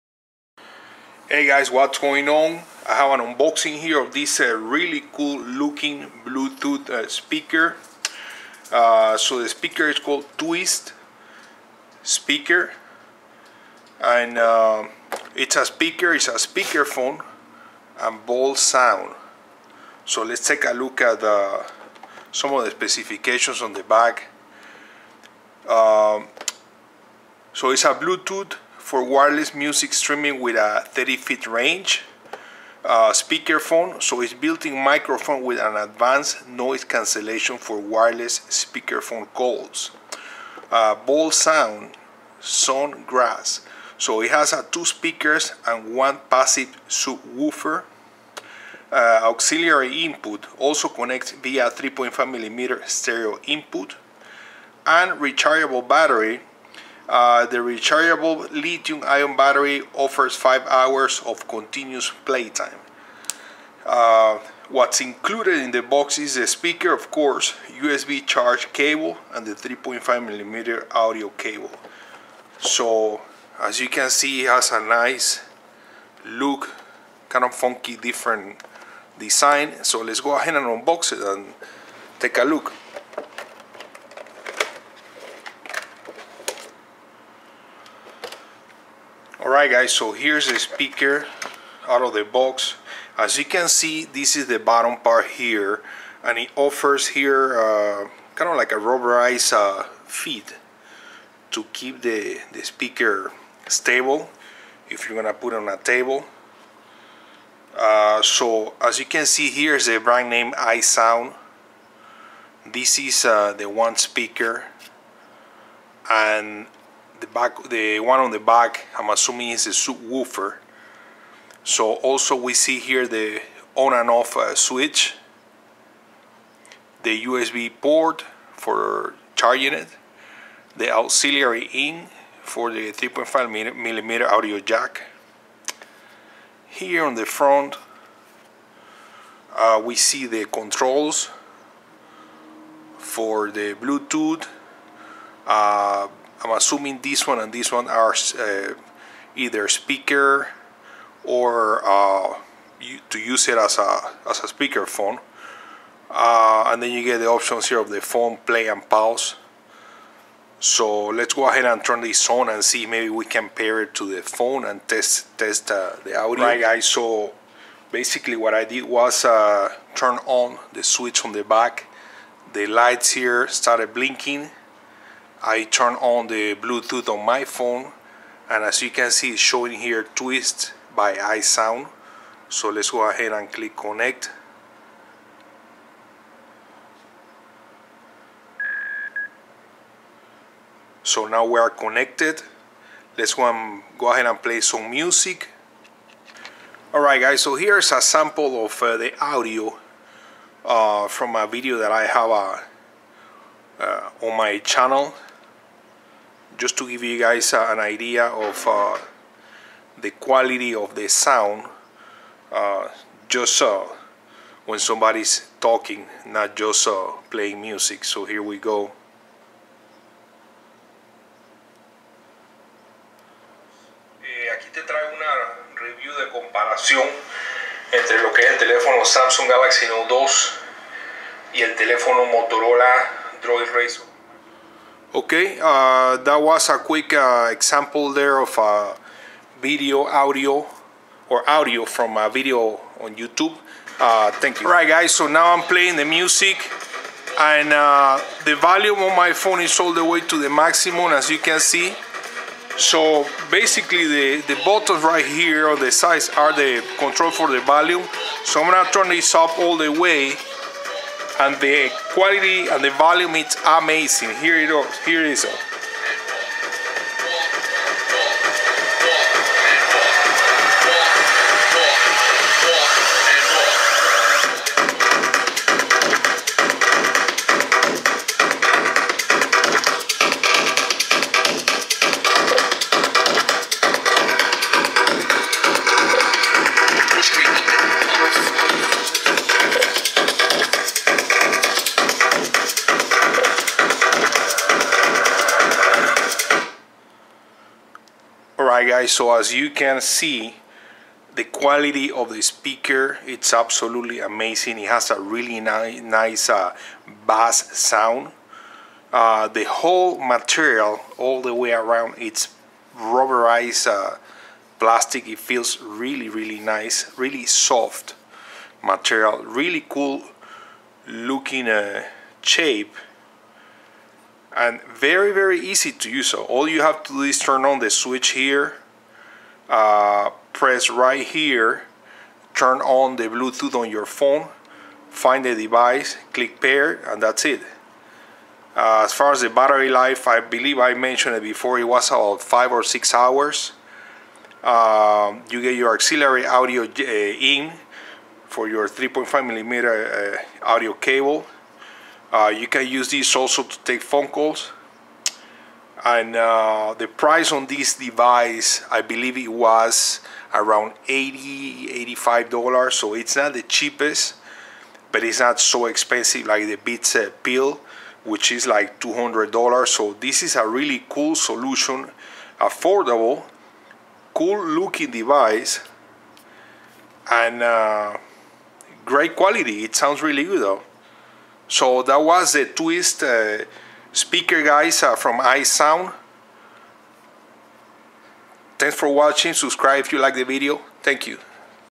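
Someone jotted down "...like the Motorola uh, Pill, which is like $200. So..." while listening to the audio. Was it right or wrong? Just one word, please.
wrong.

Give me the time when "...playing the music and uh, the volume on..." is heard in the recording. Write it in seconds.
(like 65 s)
245 s.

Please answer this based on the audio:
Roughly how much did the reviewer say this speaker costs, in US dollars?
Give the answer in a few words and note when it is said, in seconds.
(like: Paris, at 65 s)
$85, at 361 s.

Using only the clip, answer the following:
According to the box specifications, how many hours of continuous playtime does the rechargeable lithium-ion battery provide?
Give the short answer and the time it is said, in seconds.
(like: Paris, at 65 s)
5 hours, at 60 s.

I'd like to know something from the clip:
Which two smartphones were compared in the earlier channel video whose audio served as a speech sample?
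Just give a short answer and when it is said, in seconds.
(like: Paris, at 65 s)
Samsung Galaxy Note 2 and Motorola Droid Razr, at 229 s.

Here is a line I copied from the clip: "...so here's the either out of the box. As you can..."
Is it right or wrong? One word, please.
wrong.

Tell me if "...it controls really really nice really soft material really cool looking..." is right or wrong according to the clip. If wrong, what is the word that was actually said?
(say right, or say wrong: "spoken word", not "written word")
wrong: "feels", not "controls".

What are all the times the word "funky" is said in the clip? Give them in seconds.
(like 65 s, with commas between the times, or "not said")
77 s.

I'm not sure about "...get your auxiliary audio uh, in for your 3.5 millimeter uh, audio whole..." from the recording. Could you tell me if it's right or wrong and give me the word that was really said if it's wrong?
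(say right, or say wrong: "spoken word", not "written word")
wrong: "cable", not "whole".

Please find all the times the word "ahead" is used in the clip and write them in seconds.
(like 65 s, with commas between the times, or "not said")
80 s, 161 s, 183 s, 194 s.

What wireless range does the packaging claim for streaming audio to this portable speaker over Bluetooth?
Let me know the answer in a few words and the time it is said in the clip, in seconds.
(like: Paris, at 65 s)
30 feet, at 30 s.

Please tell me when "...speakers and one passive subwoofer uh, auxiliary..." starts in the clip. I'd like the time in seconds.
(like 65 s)
44 s.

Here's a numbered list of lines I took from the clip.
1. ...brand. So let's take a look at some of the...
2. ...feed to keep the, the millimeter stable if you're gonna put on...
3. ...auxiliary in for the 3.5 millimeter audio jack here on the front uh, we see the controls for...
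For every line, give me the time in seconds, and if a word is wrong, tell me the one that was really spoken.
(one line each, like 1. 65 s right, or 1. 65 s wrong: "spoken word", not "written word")
1. 18 s wrong: "sound", not "brand"
2. 100 s wrong: "speaker", not "millimeter"
3. 130 s right.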